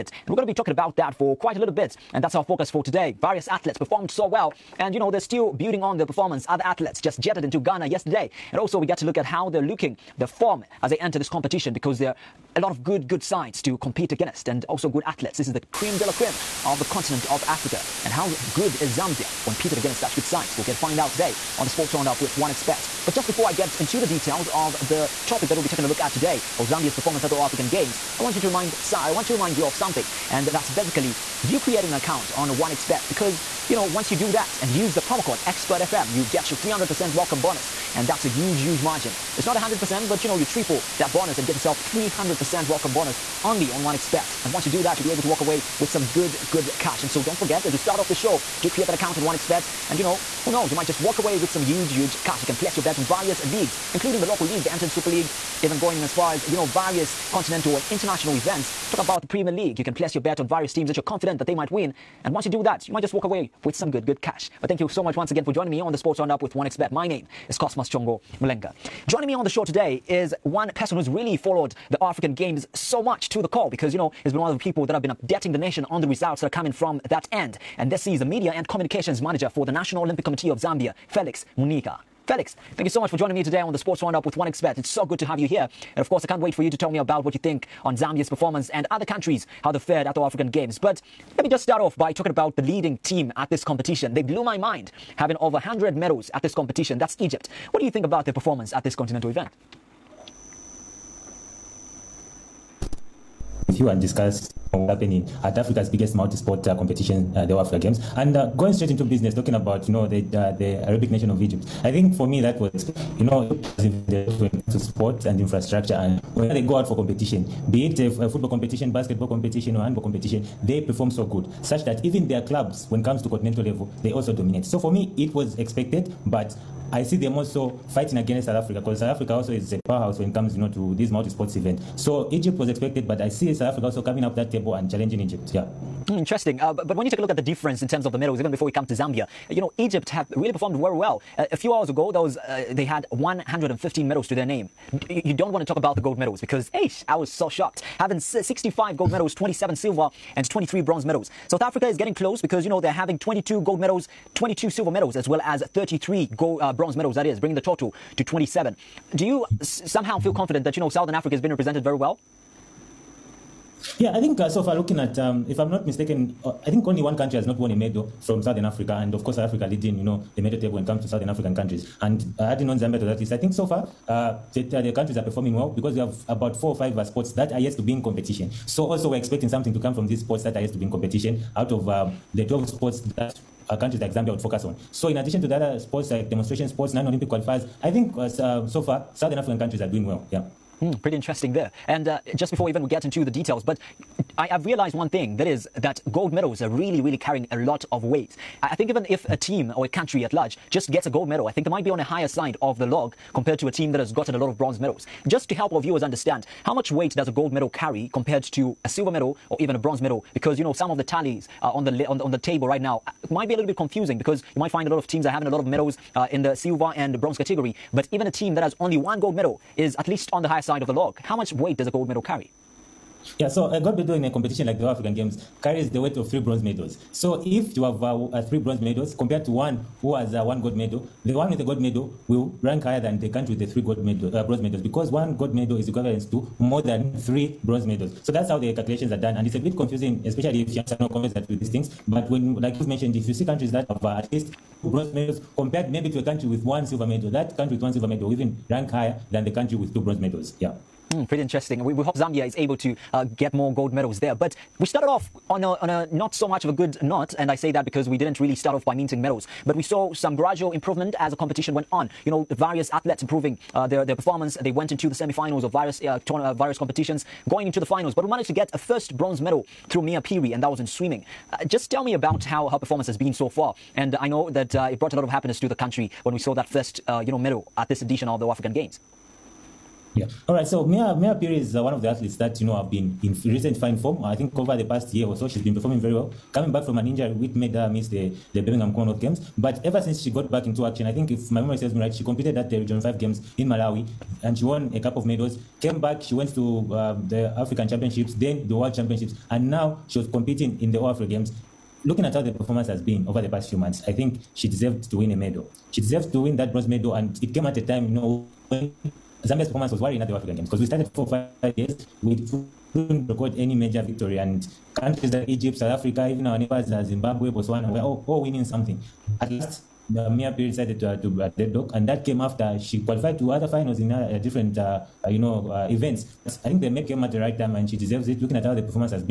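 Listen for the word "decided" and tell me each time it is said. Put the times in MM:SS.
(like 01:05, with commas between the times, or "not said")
05:20.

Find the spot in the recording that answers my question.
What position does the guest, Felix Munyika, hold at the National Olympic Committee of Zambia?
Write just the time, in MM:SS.
01:18.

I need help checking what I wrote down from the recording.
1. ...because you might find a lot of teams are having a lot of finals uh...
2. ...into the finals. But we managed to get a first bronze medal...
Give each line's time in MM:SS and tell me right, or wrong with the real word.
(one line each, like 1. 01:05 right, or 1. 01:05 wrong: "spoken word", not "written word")
1. 03:34 wrong: "medals", not "finals"
2. 04:27 right.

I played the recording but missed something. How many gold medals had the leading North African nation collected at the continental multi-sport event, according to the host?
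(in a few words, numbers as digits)
65.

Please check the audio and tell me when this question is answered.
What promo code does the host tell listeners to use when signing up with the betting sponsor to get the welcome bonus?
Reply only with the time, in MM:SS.
00:35.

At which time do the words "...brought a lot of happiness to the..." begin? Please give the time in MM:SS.
04:34.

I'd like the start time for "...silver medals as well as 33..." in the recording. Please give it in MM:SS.
02:34.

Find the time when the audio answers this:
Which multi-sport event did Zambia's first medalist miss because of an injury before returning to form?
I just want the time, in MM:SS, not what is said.
04:48.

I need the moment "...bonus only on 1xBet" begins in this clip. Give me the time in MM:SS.
00:42.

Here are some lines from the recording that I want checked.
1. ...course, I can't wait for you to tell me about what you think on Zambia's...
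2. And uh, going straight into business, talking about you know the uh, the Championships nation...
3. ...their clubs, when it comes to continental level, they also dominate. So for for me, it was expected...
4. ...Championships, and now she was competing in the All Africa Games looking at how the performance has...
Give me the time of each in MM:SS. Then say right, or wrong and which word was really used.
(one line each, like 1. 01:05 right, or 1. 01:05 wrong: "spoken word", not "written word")
1. 01:26 right
2. 01:48 wrong: "Arabic", not "Championships"
3. 02:02 right
4. 04:58 right.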